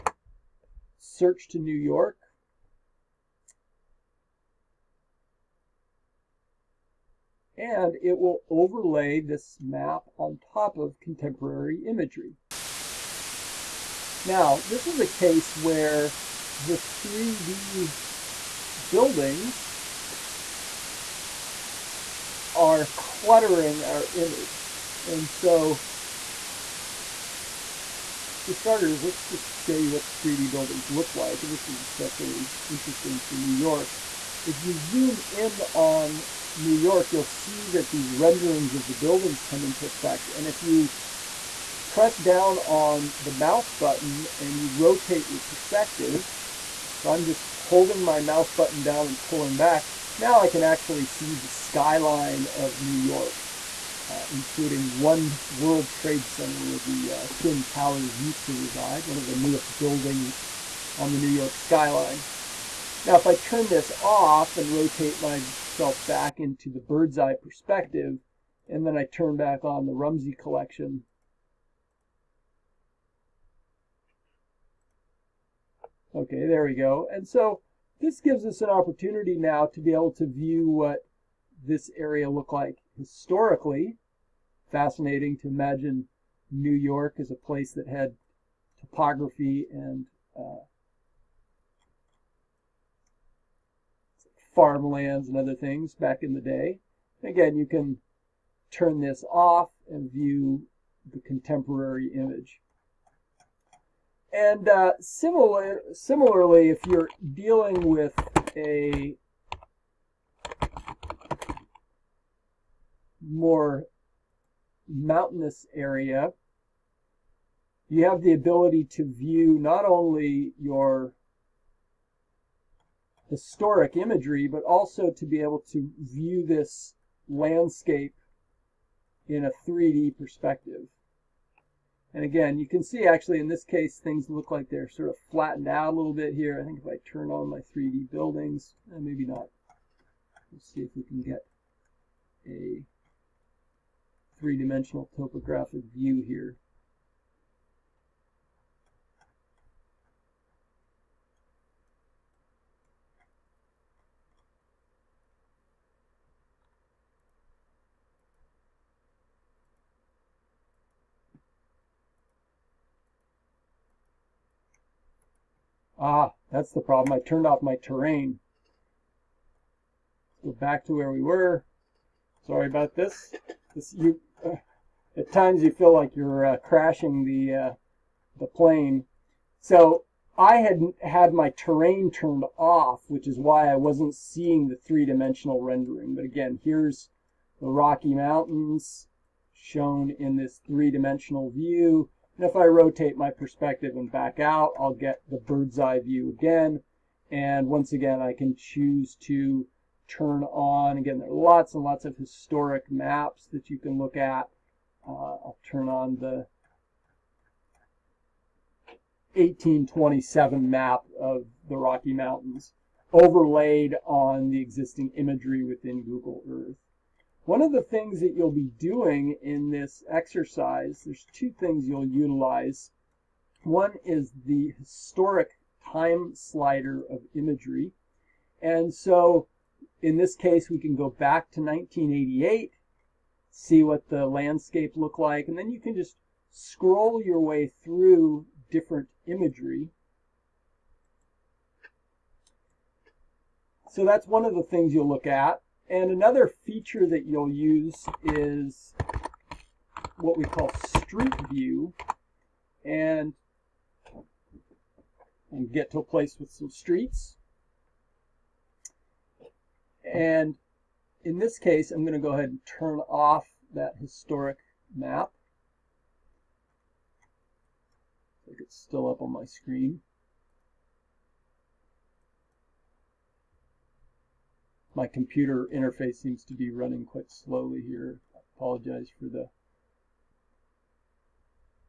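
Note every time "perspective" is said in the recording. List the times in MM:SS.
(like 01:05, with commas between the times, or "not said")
00:45, 01:07, 02:10, 03:13.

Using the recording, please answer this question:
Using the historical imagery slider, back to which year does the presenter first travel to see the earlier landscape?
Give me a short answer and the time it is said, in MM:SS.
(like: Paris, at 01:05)
1988, at 03:51.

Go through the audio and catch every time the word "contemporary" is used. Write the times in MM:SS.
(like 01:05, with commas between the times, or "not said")
00:10, 01:41.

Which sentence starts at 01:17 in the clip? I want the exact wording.
And so this gives us an opportunity now to be able to view what this area looked like historically.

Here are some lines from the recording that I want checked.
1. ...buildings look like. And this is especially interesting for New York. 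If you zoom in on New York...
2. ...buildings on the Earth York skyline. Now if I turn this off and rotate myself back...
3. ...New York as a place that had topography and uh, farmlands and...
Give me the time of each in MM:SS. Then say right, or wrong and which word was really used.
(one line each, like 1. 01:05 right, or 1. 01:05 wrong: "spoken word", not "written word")
1. 00:30 right
2. 00:59 wrong: "New", not "Earth"
3. 01:26 right.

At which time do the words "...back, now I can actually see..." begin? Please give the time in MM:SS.
00:49.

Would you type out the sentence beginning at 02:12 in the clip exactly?
And again, you can see actually in this case, things look like they're sort of flattened out a little bit here.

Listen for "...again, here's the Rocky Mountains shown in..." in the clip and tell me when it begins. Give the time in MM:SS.
03:06.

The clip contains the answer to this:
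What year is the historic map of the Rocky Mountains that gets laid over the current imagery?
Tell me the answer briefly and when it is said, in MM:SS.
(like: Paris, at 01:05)
1827, at 03:29.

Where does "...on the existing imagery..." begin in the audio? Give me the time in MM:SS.
03:34.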